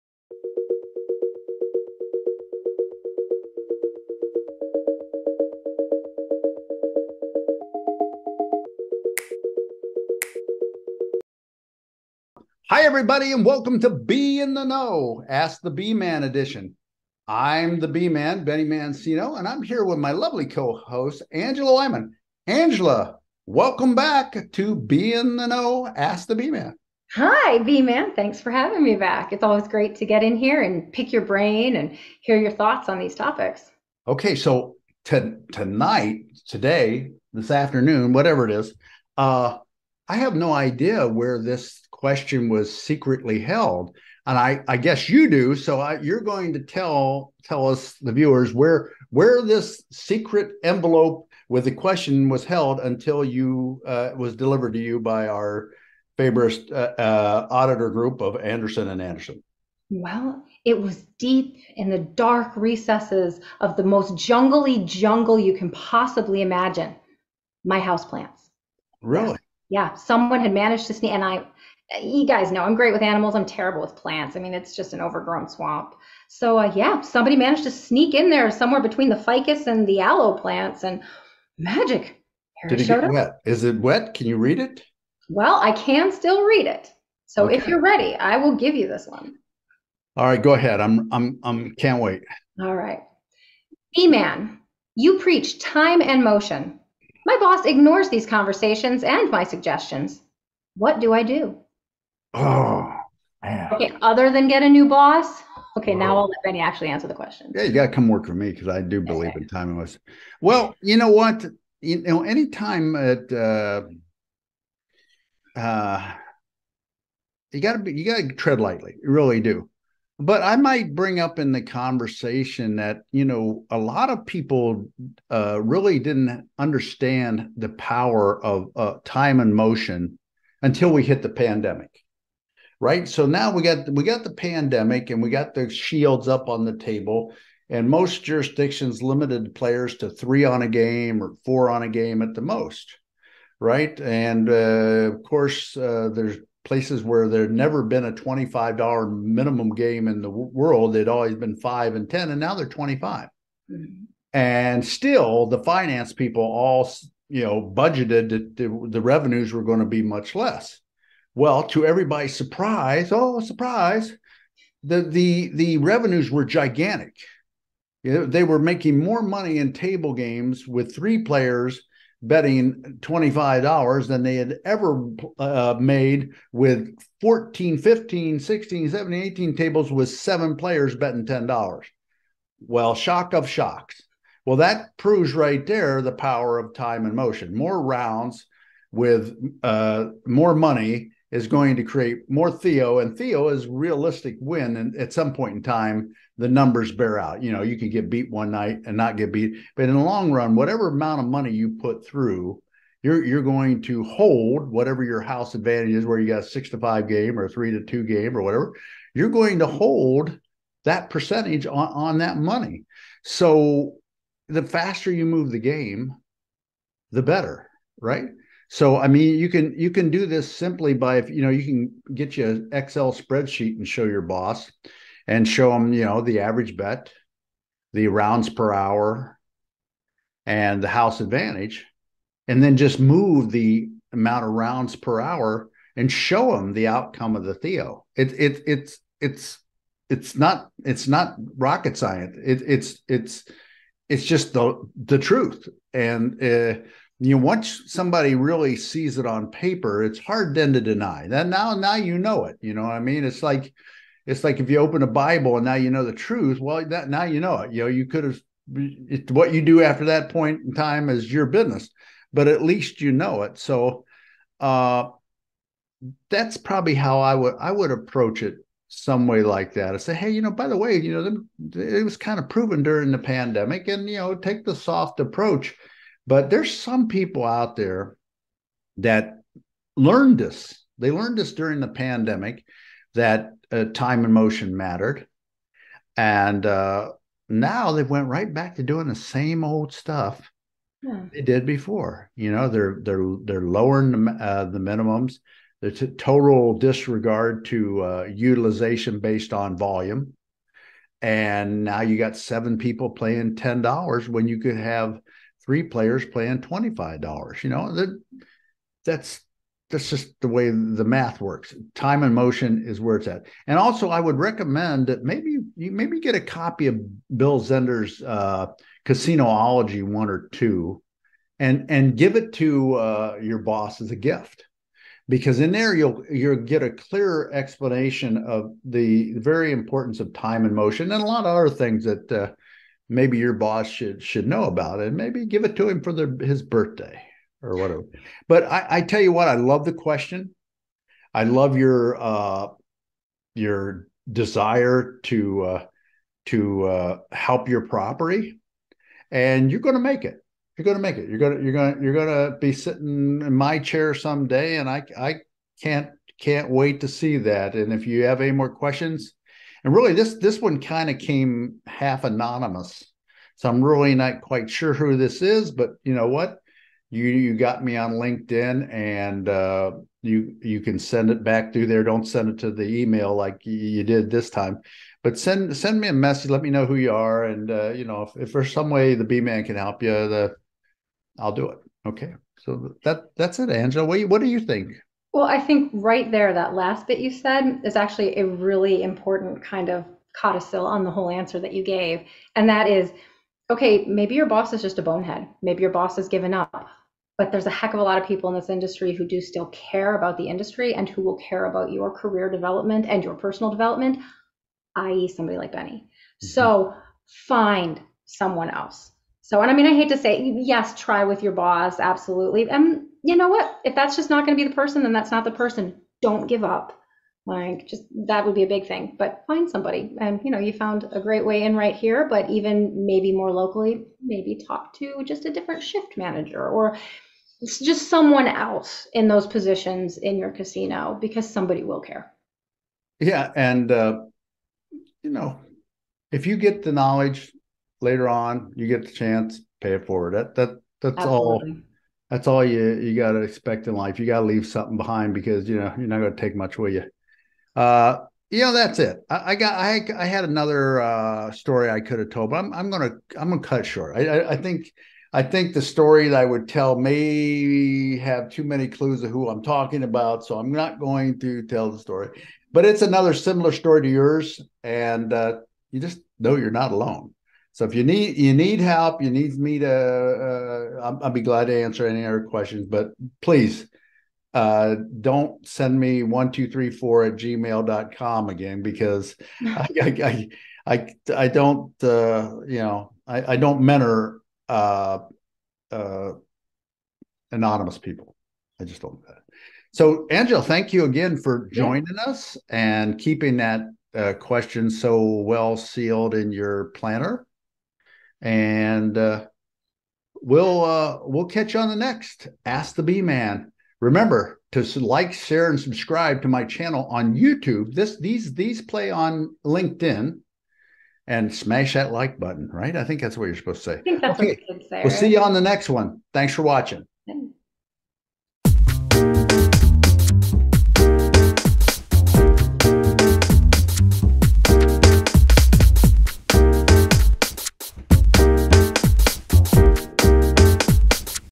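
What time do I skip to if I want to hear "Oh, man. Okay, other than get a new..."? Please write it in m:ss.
1:42.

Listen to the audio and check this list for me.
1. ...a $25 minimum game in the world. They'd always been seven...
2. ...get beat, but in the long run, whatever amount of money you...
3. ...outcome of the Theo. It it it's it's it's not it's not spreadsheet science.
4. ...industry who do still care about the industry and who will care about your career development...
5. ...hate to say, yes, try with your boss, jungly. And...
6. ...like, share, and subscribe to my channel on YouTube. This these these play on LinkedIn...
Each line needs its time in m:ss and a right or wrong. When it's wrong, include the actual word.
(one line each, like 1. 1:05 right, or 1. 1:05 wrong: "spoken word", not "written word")
1. 2:28 wrong: "five", not "seven"
2. 3:19 right
3. 3:56 wrong: "rocket", not "spreadsheet"
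4. 6:38 right
5. 6:49 wrong: "absolutely", not "jungly"
6. 8:24 right.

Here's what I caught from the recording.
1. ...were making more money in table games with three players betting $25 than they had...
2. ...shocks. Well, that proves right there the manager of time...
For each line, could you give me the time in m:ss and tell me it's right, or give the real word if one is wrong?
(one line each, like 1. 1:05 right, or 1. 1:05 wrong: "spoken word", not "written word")
1. 2:48 right
2. 3:03 wrong: "power", not "manager".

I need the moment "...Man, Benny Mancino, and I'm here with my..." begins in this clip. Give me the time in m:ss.
0:18.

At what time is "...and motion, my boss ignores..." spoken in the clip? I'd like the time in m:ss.
1:36.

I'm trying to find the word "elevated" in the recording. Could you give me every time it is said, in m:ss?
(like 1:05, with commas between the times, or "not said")
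not said.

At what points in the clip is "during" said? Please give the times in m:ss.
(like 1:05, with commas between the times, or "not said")
4:32, 4:41.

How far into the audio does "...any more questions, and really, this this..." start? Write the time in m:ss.
5:58.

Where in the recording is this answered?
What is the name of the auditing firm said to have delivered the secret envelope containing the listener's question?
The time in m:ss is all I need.
0:58.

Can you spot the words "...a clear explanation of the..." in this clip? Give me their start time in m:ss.
5:26.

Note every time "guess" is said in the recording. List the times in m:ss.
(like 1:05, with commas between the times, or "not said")
0:44.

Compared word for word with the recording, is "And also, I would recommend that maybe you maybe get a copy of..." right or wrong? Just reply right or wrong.
right.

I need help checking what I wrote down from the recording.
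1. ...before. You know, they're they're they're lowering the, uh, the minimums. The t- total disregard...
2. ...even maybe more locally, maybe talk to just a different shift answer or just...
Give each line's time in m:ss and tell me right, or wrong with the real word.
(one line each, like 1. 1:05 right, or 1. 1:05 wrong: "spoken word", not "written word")
1. 4:51 right
2. 7:02 wrong: "manager", not "answer".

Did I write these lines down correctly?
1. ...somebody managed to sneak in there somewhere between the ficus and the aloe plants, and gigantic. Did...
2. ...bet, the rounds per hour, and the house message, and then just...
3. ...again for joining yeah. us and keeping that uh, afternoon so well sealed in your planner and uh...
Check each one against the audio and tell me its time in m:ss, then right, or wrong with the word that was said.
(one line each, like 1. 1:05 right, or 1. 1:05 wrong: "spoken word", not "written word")
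1. 1:16 wrong: "magic", not "gigantic"
2. 3:46 wrong: "advantage", not "message"
3. 8:11 wrong: "question", not "afternoon".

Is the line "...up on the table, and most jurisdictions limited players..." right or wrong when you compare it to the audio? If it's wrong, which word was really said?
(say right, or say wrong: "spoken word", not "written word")
right.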